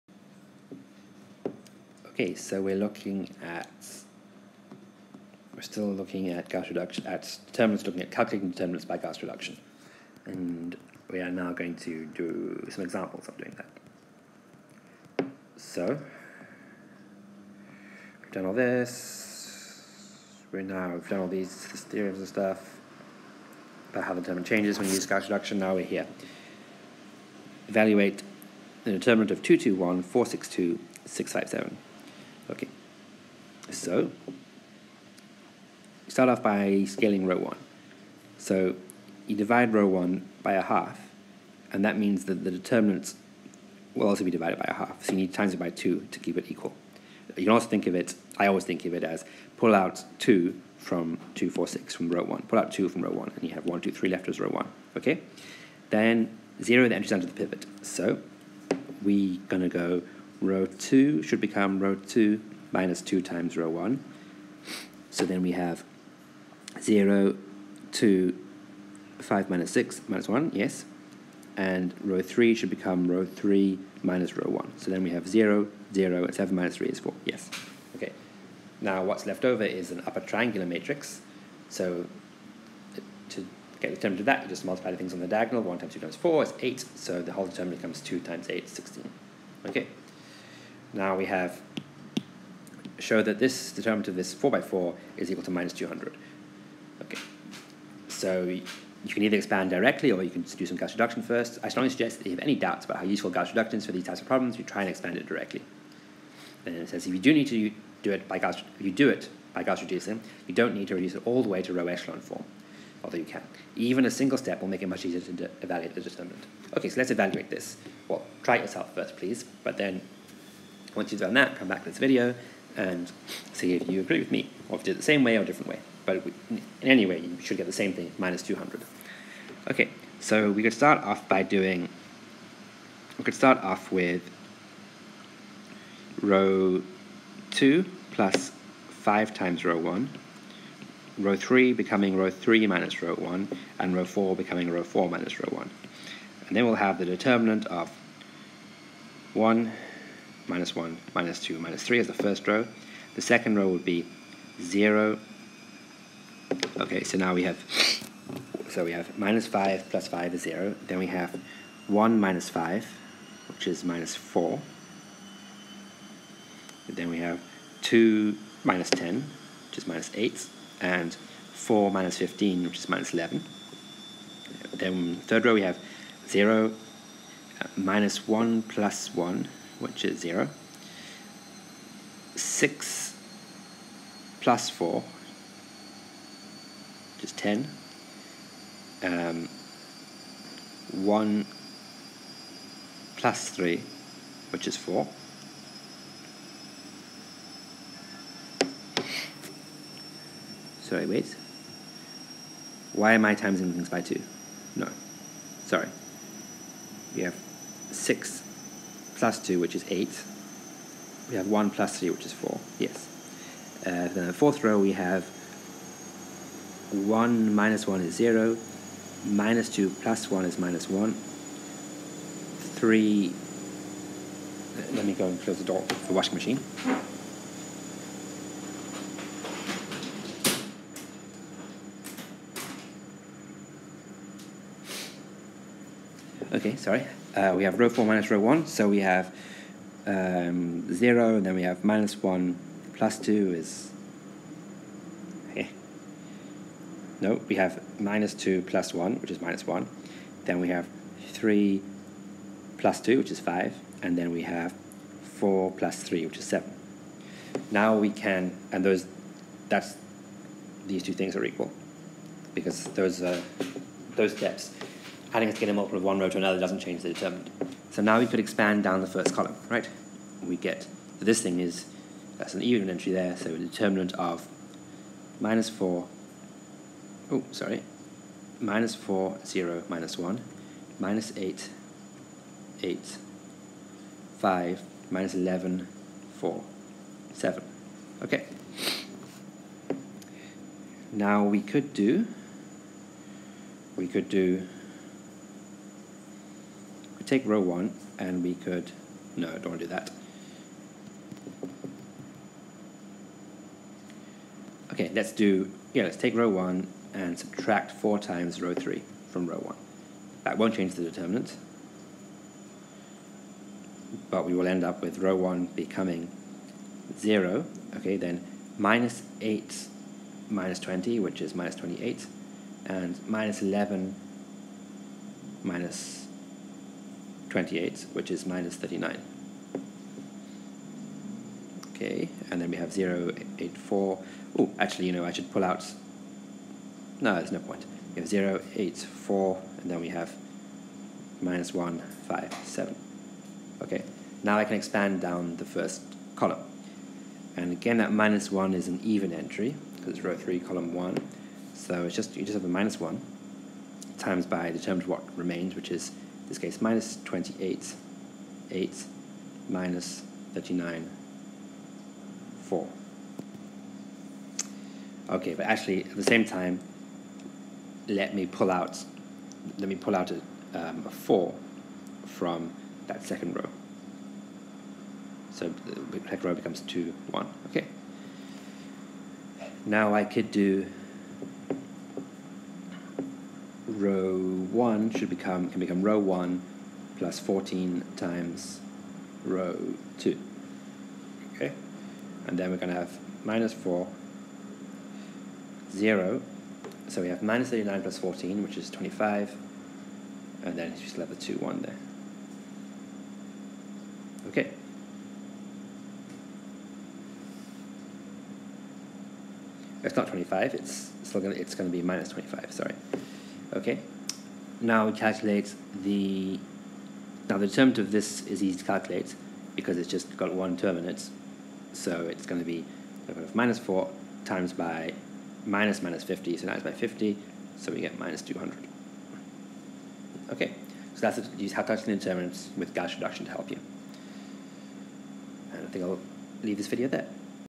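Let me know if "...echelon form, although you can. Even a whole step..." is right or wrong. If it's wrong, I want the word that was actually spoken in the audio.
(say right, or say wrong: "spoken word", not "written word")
wrong: "single", not "whole".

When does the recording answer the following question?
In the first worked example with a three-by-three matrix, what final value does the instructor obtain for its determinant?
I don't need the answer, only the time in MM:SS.
01:28.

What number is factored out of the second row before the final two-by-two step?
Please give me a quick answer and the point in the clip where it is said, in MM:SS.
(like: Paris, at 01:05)
4, at 06:11.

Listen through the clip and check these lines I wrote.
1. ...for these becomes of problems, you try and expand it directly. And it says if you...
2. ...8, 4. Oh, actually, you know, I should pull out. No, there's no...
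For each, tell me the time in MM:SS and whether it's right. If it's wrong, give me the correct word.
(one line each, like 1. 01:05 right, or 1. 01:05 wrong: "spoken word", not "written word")
1. 01:43 wrong: "types", not "becomes"
2. 05:33 right.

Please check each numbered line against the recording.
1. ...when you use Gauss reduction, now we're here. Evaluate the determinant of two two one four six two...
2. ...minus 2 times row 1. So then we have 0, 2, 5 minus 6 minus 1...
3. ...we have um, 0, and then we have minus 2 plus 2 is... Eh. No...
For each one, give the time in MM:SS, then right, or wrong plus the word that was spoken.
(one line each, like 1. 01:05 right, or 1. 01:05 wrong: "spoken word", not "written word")
1. 00:24 right
2. 01:02 right
3. 03:58 wrong: "1", not "2".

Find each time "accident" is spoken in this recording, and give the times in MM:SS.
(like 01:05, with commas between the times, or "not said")
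not said.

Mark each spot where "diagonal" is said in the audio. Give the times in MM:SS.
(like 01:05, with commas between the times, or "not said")
01:25.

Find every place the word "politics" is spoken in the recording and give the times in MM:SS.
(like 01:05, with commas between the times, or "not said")
not said.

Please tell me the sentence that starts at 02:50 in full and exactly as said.
And 4 minus 15, which is minus 11.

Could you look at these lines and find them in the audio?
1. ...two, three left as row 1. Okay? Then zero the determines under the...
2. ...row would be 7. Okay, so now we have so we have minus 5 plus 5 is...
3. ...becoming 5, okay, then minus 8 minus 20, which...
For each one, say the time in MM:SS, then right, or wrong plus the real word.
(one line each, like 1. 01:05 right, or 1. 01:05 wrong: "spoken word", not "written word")
1. 00:53 wrong: "entries", not "determines"
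2. 02:33 wrong: "0", not "7"
3. 05:15 wrong: "0", not "5".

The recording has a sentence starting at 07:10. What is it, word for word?
Okay, so that's use how calculating determinants with Gauss reduction to help you.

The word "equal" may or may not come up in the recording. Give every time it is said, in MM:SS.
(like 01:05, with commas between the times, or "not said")
00:46, 01:35, 04:21.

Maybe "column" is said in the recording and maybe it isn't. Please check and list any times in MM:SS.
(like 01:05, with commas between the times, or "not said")
04:29, 05:46, 05:50.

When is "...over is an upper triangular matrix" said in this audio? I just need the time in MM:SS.
01:19.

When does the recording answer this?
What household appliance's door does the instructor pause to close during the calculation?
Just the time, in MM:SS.
03:46.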